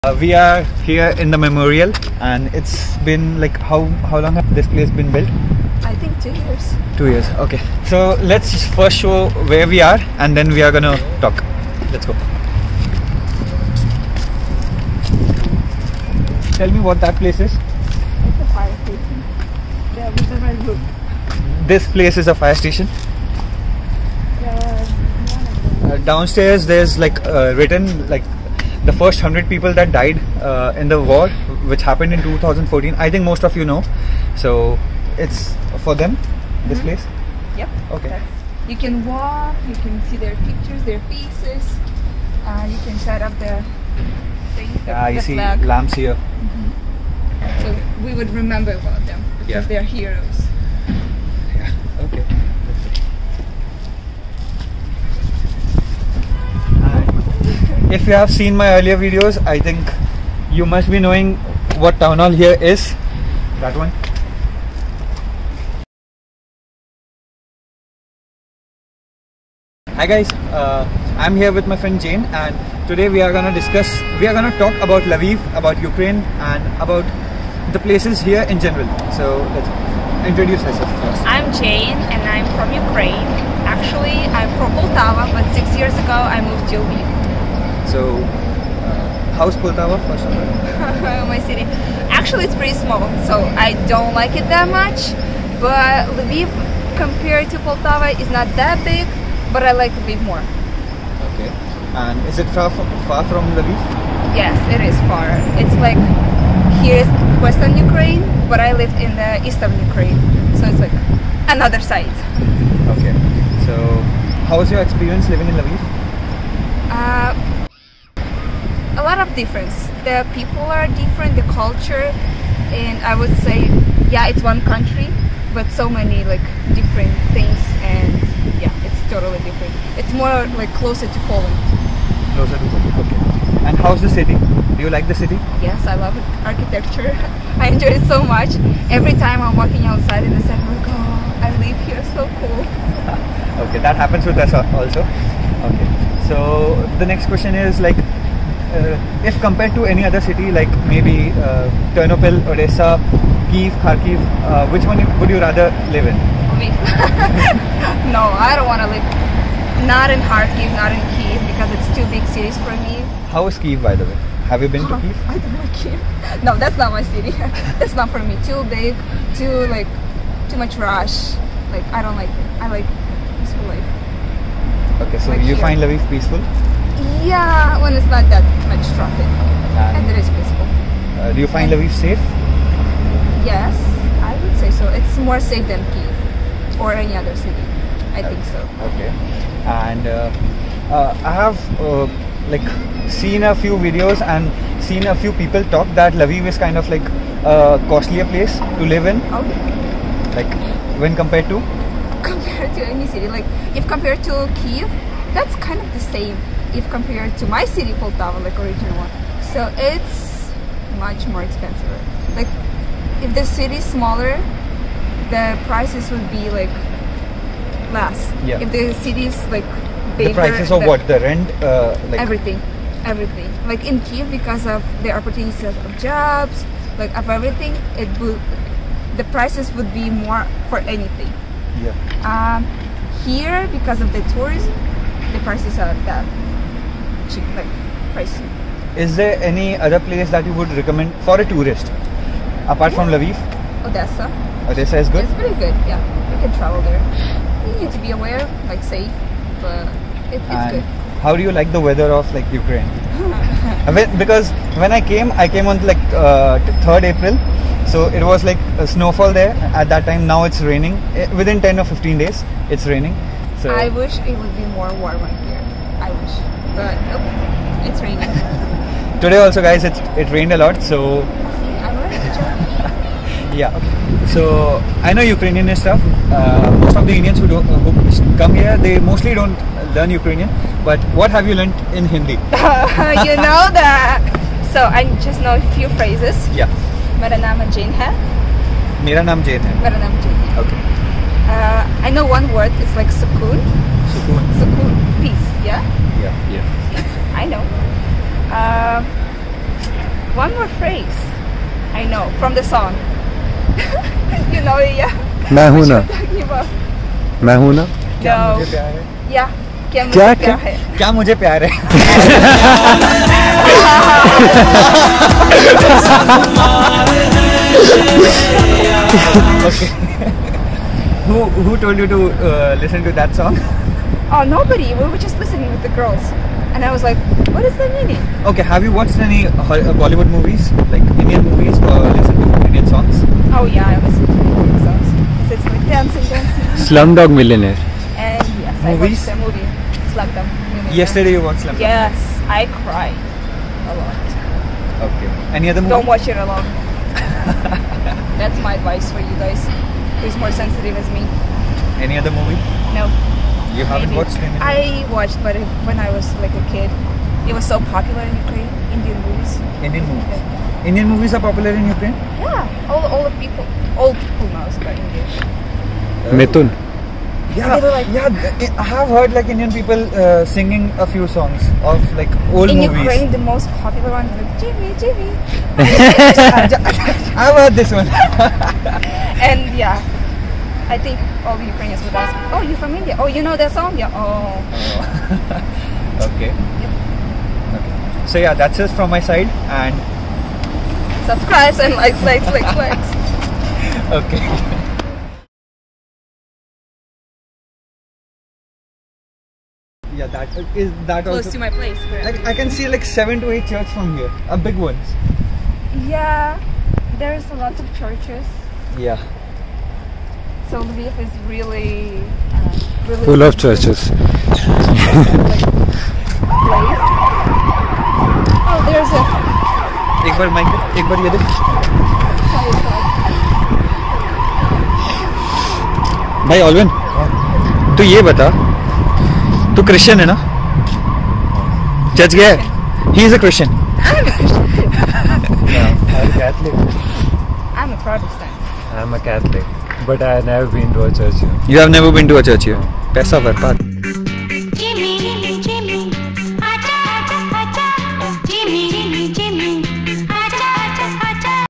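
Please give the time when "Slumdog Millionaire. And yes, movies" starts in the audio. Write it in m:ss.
5:36.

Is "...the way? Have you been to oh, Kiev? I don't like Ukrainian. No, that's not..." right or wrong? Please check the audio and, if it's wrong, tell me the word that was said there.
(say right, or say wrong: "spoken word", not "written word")
wrong: "Kiev", not "Ukrainian".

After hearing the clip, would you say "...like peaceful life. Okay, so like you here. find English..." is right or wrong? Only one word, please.
wrong.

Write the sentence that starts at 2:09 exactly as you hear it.
It's more like closer to Poland.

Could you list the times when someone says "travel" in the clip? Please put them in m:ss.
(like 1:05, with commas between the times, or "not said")
4:06.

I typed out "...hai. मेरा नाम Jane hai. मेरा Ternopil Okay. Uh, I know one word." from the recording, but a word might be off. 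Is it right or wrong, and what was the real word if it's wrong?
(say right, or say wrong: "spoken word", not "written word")
wrong: "Jane", not "Ternopil".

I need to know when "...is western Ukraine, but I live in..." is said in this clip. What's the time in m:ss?
1:47.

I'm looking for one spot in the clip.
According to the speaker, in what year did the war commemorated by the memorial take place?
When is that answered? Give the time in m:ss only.
0:32.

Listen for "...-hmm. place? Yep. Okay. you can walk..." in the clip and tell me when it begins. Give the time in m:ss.
0:36.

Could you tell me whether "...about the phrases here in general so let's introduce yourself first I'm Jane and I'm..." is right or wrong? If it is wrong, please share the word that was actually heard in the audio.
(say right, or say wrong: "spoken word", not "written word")
wrong: "places", not "phrases".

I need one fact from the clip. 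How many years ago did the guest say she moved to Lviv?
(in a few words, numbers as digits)
6.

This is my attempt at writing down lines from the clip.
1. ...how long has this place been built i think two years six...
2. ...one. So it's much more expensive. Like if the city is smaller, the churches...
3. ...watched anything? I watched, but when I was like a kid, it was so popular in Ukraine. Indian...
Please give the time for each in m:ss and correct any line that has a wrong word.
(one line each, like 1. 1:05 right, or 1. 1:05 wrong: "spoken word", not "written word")
1. 0:04 wrong: "two", not "six"
2. 3:28 wrong: "prices", not "churches"
3. 5:54 right.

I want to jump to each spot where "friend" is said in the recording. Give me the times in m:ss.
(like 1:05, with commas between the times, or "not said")
1:11.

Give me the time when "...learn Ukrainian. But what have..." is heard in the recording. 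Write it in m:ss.
4:39.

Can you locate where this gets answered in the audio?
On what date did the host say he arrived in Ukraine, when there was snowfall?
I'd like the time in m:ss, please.
4:16.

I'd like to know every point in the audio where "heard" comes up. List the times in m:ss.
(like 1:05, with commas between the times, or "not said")
6:09, 6:17.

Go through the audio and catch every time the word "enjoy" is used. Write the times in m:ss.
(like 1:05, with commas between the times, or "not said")
2:17.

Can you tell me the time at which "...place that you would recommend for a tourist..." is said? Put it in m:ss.
4:00.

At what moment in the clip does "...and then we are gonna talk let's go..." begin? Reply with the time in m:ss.
0:10.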